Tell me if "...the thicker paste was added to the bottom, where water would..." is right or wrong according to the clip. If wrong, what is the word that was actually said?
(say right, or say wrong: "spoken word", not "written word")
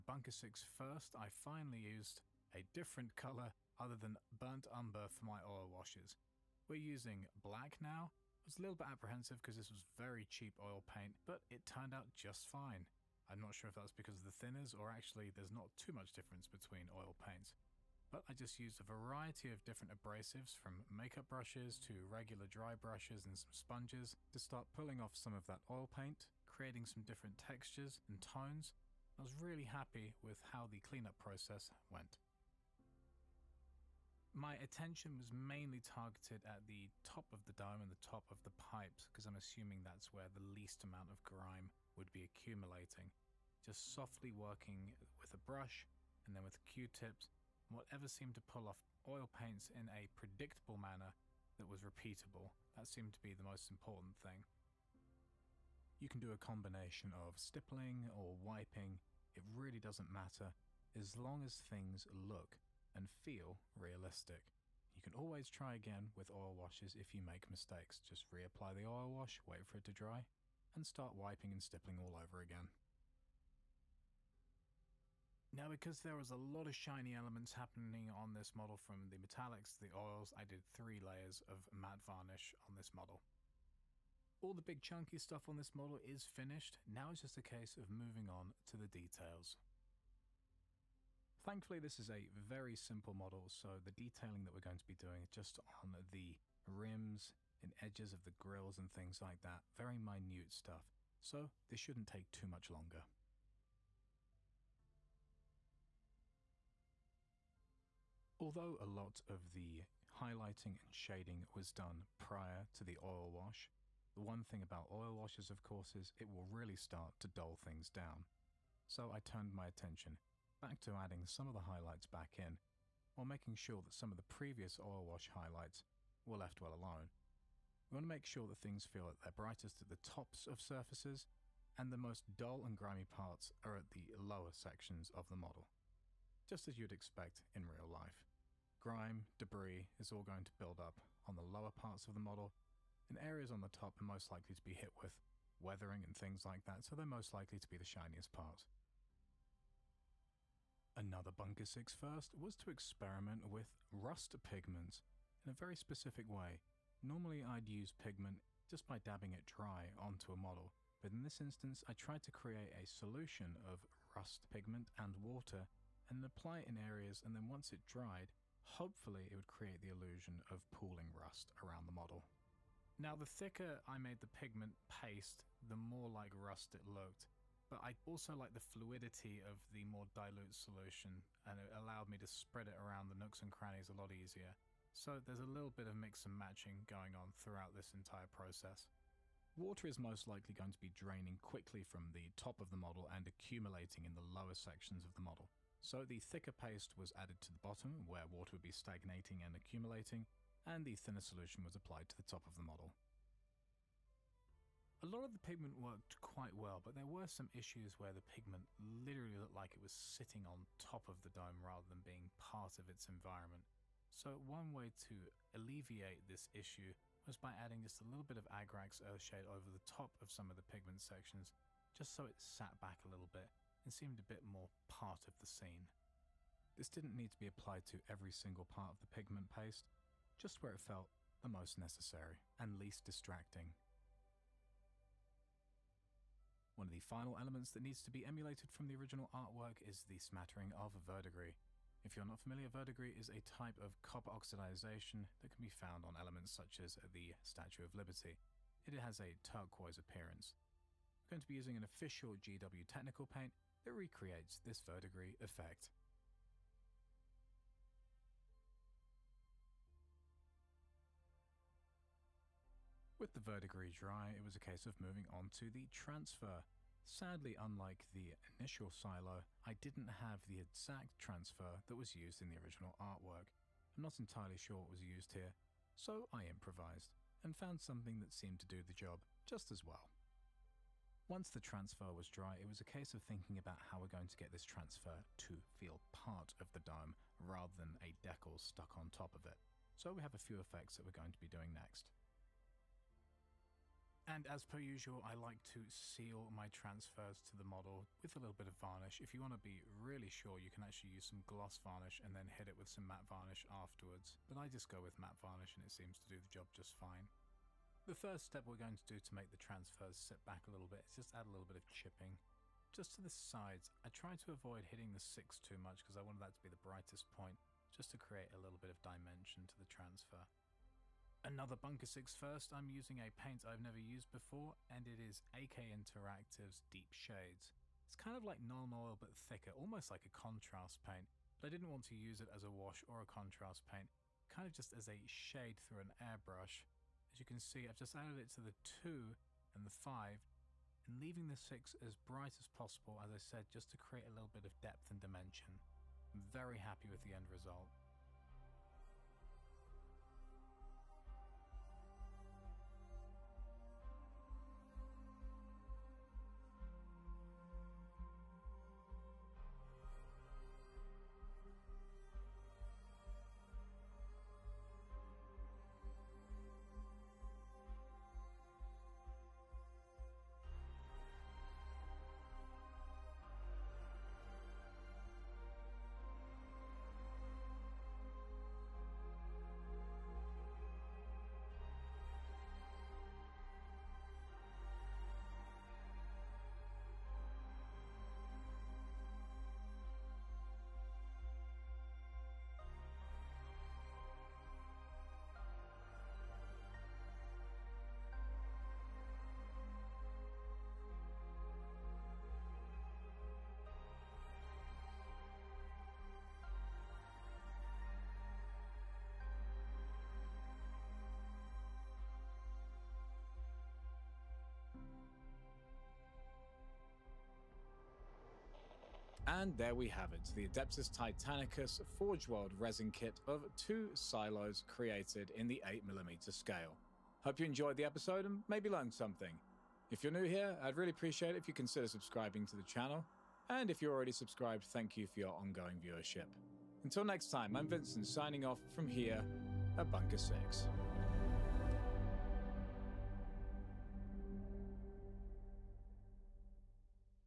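right.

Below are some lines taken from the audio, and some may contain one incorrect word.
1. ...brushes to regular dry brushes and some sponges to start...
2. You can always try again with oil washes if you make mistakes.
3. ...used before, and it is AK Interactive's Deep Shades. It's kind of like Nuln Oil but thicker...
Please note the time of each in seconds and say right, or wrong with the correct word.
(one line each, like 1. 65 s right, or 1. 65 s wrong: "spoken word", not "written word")
1. 21 s right
2. 64 s right
3. 323 s right.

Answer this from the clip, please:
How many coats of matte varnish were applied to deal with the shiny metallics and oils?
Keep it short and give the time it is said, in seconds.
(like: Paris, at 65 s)
3, at 80 s.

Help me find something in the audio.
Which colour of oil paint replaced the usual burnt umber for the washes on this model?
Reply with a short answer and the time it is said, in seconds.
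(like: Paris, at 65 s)
Black, at 6 s.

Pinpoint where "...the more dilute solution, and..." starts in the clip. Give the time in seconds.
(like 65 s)
179 s.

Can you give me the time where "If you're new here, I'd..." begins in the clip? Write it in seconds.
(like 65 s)
430 s.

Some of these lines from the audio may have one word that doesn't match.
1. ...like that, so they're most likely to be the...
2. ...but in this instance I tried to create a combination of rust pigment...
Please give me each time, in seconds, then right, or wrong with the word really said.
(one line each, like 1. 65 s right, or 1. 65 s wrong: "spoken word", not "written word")
1. 146 s right
2. 160 s wrong: "solution", not "combination".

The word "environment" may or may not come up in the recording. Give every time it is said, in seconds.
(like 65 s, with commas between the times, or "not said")
213 s.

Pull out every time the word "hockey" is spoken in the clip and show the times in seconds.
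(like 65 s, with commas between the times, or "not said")
not said.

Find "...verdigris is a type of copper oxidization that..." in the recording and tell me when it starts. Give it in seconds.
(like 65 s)
242 s.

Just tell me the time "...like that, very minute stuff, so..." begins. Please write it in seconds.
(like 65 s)
99 s.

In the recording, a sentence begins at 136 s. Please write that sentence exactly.
Just as you'd expect in real life.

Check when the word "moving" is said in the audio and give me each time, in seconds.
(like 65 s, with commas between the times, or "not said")
87 s, 264 s.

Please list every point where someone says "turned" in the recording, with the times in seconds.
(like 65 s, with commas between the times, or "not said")
11 s, 119 s.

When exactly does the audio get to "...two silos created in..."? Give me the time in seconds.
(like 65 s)
423 s.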